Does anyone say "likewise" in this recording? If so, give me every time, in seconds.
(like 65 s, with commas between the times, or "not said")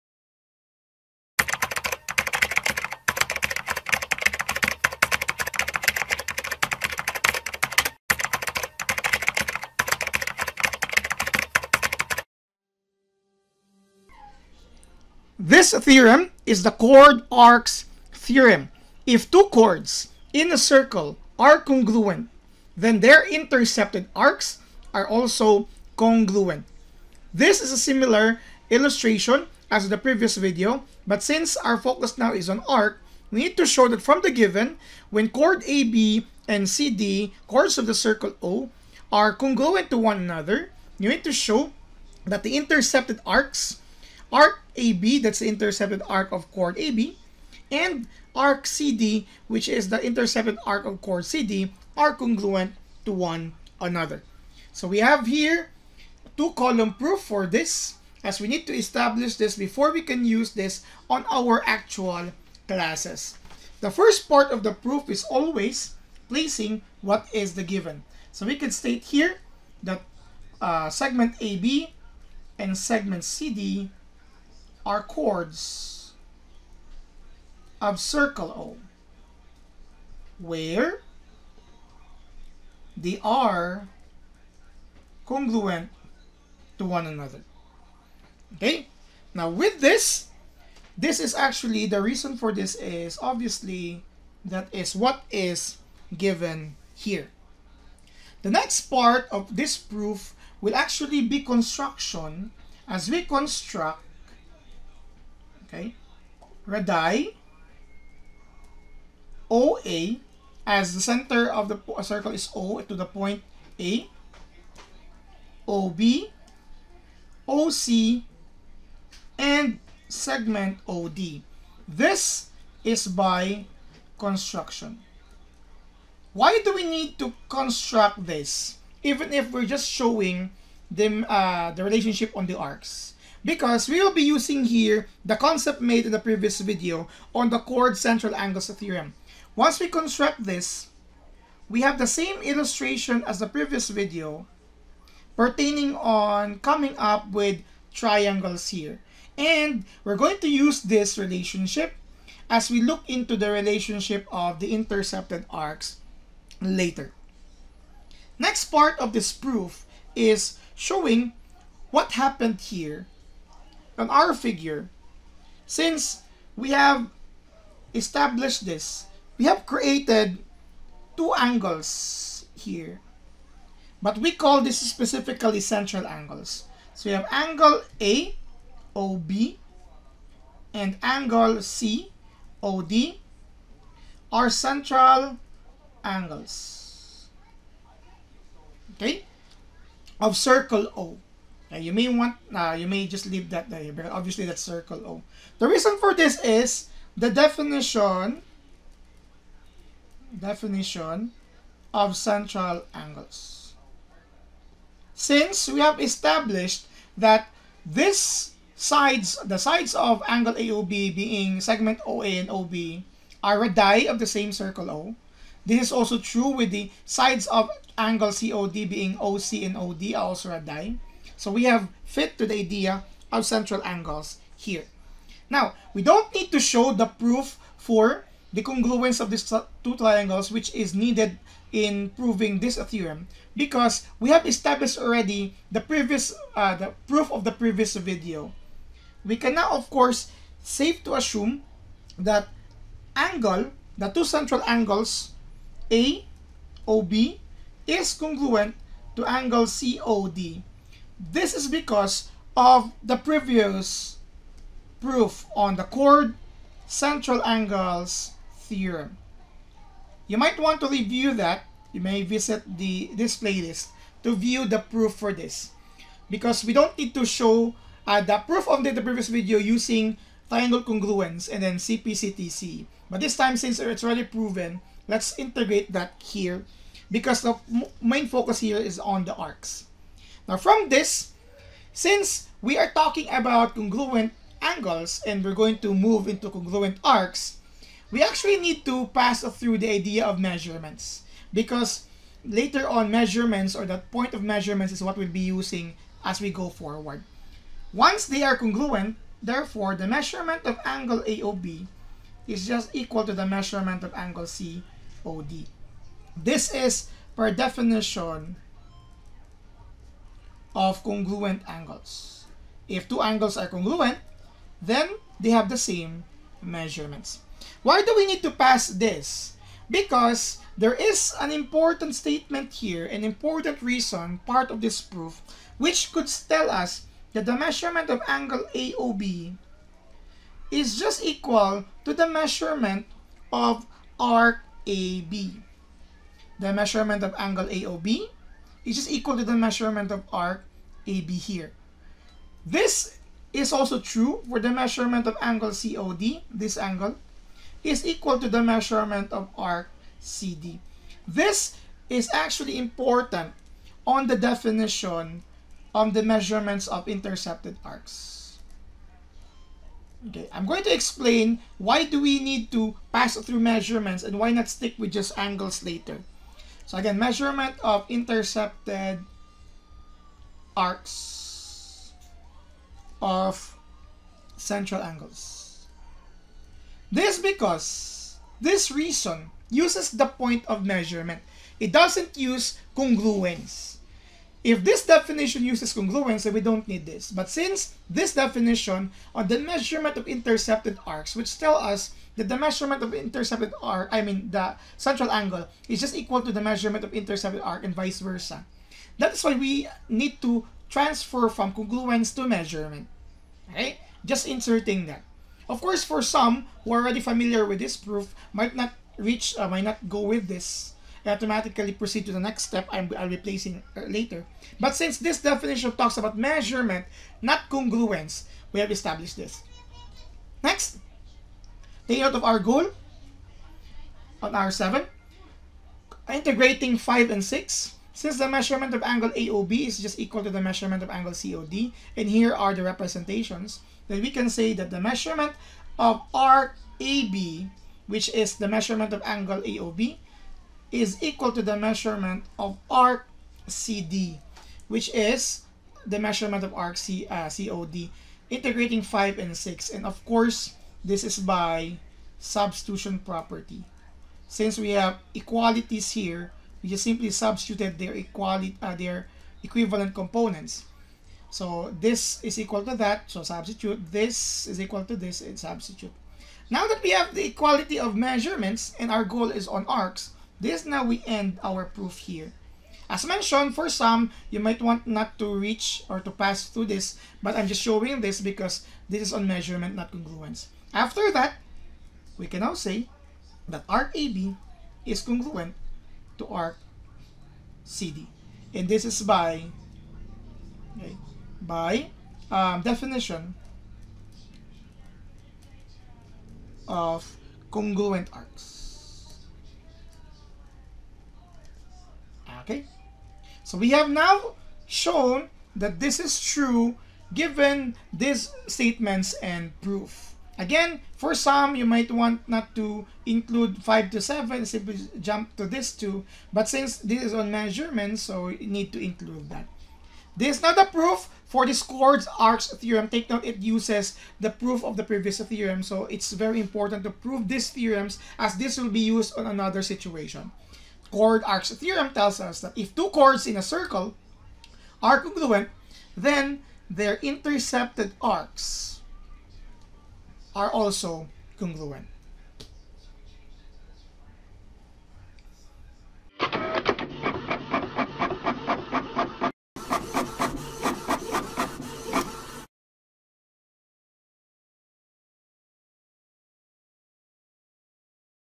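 not said.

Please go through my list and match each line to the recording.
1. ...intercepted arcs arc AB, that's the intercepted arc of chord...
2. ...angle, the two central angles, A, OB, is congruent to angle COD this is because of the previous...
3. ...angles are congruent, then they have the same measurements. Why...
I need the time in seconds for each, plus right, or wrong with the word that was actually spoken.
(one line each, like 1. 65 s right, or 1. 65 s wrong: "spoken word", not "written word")
1. 42 s right
2. 243 s right
3. 313 s right.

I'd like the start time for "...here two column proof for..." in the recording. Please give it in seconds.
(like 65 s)
55 s.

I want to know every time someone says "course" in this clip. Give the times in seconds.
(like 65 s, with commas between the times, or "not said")
239 s, 405 s, 450 s.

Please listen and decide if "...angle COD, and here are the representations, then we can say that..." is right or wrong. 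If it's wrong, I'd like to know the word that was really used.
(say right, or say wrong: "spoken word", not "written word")
right.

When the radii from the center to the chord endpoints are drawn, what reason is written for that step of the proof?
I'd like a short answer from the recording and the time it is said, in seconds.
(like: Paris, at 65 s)
By construction, at 121 s.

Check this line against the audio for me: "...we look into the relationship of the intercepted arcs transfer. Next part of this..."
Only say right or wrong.
wrong.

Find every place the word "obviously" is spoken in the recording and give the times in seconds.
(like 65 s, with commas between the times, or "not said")
93 s, 194 s.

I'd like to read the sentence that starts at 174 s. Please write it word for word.
But we call this specifically central angles.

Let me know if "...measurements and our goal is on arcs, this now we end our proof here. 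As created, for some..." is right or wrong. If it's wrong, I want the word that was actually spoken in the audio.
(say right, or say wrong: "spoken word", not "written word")
wrong: "mentioned", not "created".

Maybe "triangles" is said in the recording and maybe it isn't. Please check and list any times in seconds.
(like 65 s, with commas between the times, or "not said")
147 s, 229 s, 270 s.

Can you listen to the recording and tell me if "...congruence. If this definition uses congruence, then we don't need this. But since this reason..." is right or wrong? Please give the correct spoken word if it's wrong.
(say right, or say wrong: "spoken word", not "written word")
wrong: "definition", not "reason".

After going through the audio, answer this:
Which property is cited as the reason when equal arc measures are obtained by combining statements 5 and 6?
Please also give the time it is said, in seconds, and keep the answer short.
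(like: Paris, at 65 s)
Substitution property, at 452 s.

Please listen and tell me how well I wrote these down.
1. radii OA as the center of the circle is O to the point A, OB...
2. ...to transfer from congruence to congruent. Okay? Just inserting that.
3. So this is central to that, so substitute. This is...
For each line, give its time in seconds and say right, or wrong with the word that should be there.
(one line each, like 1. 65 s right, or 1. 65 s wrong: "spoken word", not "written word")
1. 106 s right
2. 400 s wrong: "measurement", not "congruent"
3. 461 s wrong: "equal", not "central".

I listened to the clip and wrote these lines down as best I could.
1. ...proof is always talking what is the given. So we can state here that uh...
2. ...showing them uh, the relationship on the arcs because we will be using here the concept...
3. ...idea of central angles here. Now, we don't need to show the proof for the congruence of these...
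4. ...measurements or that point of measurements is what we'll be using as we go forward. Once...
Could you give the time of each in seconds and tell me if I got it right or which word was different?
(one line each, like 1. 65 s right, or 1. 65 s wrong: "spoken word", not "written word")
1. 64 s wrong: "placing", not "talking"
2. 129 s right
3. 222 s right
4. 293 s right.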